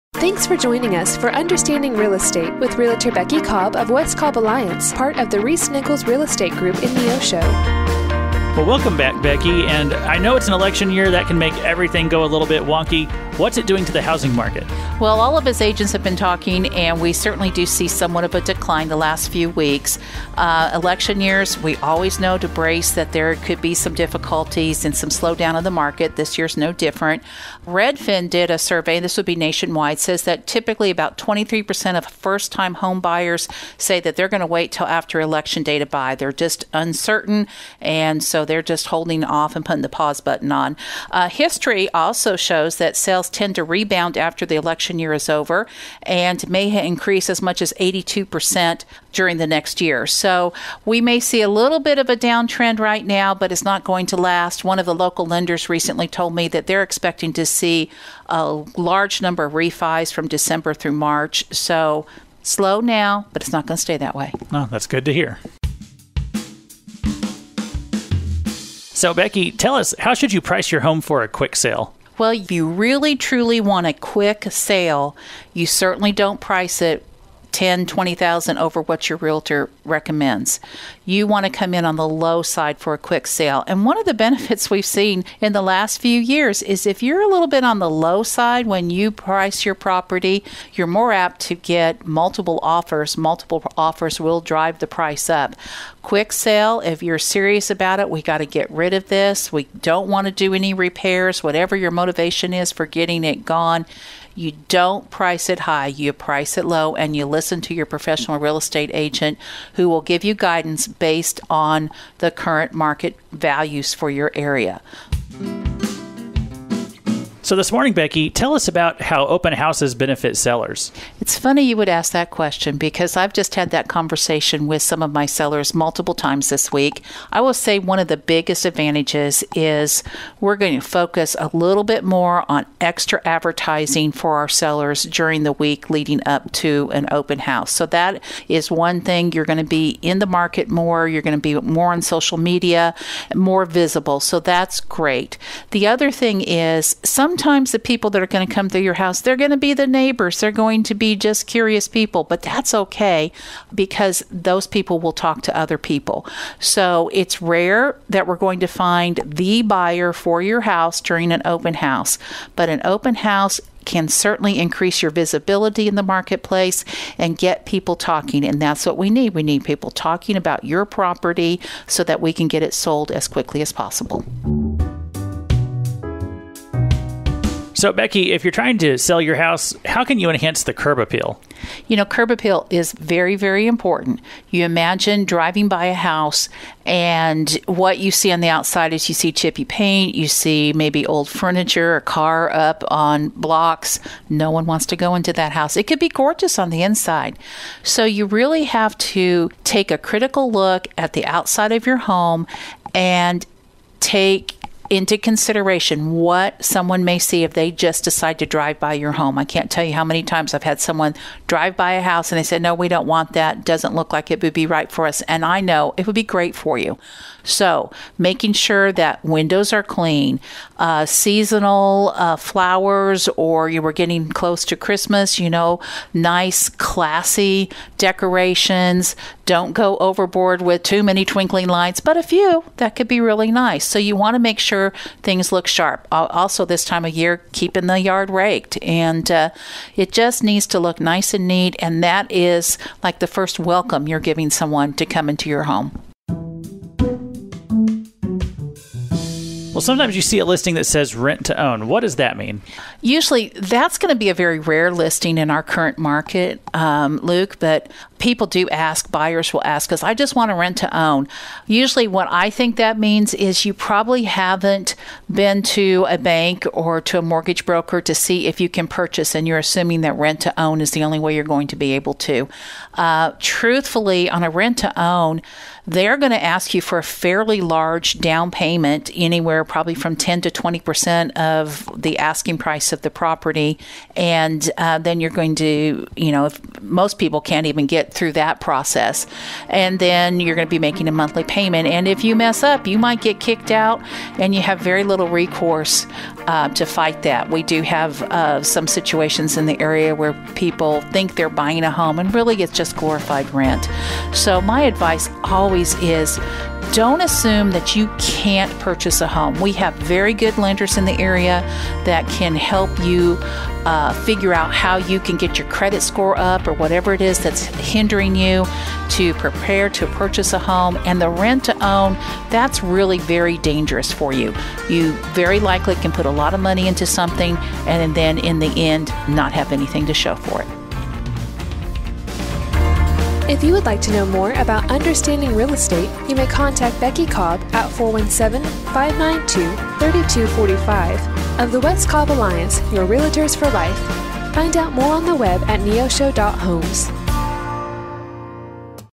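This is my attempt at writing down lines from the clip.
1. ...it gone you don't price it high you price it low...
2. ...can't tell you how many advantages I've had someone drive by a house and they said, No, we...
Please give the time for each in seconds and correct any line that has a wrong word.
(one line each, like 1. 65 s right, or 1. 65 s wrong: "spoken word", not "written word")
1. 103 s right
2. 209 s wrong: "times", not "advantages".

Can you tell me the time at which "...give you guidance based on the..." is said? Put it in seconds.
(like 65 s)
110 s.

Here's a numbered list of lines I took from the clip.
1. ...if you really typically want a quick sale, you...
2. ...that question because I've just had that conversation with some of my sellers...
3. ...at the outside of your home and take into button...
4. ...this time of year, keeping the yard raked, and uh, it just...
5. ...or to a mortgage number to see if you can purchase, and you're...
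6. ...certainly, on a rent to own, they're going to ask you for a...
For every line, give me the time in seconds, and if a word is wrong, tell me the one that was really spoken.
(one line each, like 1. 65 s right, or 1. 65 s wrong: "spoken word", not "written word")
1. 72 s wrong: "truly", not "typically"
2. 122 s right
3. 200 s wrong: "consideration", not "button"
4. 236 s right
5. 266 s wrong: "broker", not "number"
6. 273 s wrong: "truthfully", not "certainly".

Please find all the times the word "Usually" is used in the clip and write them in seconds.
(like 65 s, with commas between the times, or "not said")
253 s, 261 s.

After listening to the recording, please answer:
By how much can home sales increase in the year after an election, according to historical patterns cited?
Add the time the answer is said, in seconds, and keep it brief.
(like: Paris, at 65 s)
82%, at 47 s.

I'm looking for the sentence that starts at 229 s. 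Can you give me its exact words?
Don't go overboard with too many twinkling lights, but a few that could be really nice.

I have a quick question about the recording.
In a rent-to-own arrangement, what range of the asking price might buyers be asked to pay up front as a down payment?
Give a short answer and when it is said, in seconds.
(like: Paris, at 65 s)
10 to 20 percent, at 280 s.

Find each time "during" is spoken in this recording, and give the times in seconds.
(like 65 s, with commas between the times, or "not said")
49 s, 135 s, 161 s.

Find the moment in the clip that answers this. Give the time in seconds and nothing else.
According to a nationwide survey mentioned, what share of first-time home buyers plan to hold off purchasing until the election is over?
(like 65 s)
31 s.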